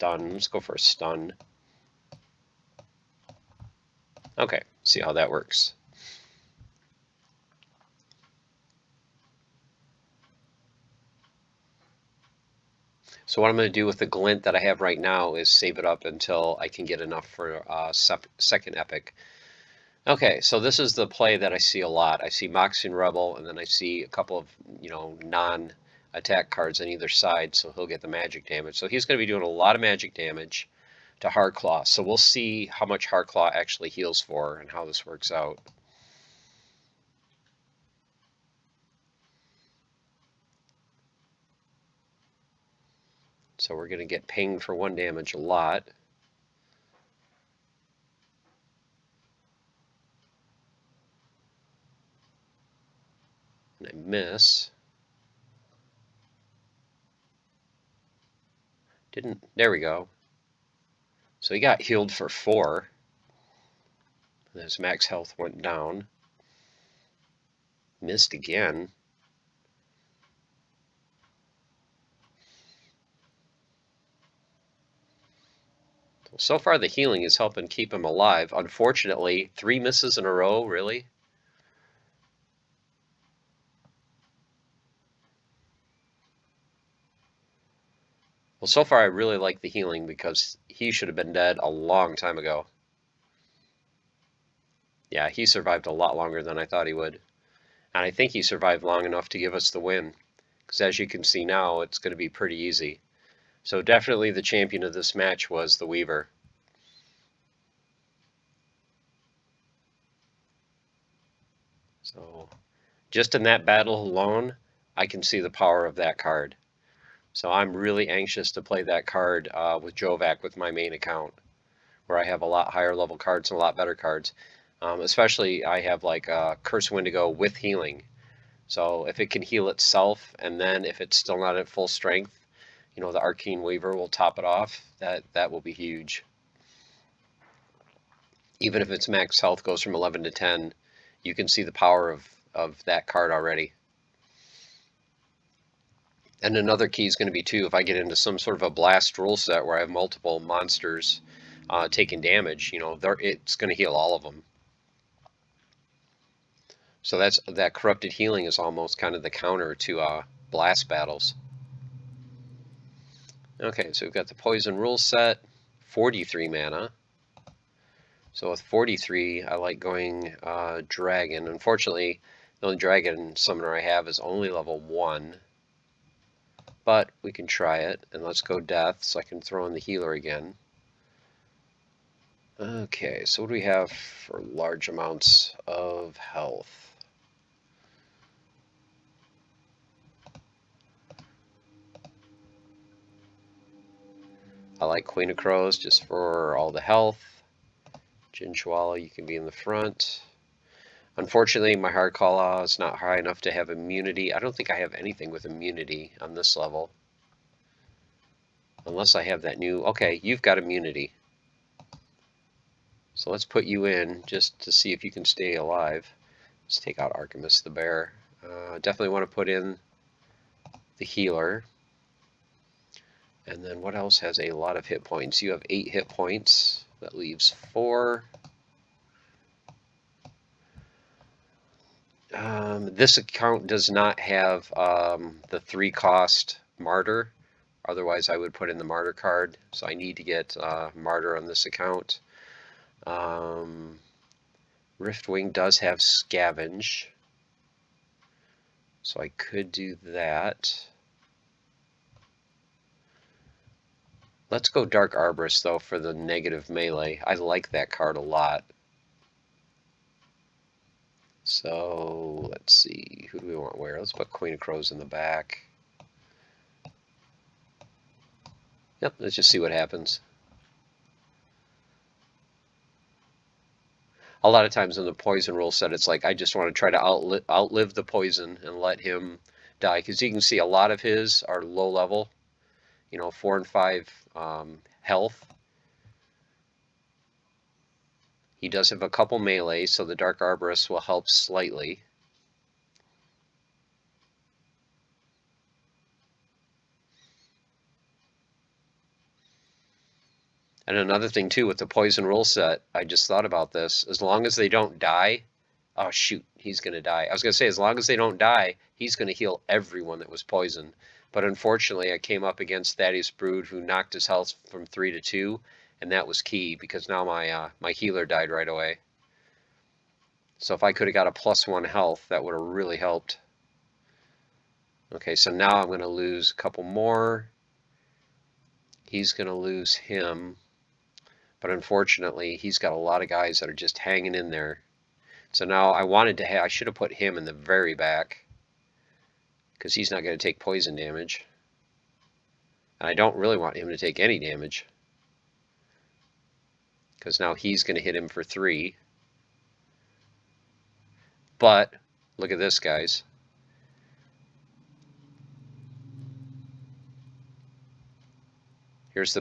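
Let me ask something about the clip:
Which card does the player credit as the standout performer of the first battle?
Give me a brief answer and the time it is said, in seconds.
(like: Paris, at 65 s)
the Weaver, at 104 s.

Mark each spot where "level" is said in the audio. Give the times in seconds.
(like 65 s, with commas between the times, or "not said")
122 s, 174 s, 206 s, 281 s.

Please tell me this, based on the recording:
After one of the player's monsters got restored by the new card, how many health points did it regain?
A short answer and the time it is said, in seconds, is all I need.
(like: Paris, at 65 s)
4, at 61 s.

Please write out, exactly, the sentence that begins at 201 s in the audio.
Unfortunately, my hard call law is not high enough to have immunity.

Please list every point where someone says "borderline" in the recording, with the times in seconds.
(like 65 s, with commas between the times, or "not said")
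not said.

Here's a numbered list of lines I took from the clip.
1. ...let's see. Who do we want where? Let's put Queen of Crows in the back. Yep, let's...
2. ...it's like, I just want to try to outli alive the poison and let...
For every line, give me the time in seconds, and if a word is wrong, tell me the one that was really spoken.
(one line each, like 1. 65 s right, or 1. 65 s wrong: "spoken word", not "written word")
1. 262 s right
2. 275 s wrong: "outlive", not "alive".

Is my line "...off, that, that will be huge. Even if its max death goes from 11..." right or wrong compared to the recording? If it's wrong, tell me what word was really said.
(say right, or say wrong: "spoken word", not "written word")
wrong: "health", not "death".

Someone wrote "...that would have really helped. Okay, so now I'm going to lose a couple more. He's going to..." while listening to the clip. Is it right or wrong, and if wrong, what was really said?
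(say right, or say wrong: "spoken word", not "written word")
right.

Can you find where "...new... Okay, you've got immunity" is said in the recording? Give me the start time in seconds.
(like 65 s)
209 s.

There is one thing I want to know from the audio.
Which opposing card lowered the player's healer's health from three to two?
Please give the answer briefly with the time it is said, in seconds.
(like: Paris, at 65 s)
Thaddeus Brood, at 312 s.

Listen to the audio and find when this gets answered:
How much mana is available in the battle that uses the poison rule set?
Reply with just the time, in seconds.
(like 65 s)
165 s.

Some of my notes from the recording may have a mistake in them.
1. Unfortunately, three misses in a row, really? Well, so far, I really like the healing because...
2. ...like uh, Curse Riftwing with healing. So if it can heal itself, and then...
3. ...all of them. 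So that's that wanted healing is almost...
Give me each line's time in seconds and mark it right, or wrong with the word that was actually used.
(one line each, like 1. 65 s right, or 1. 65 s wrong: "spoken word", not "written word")
1. 78 s right
2. 126 s wrong: "Windeku", not "Riftwing"
3. 153 s wrong: "corrupted", not "wanted".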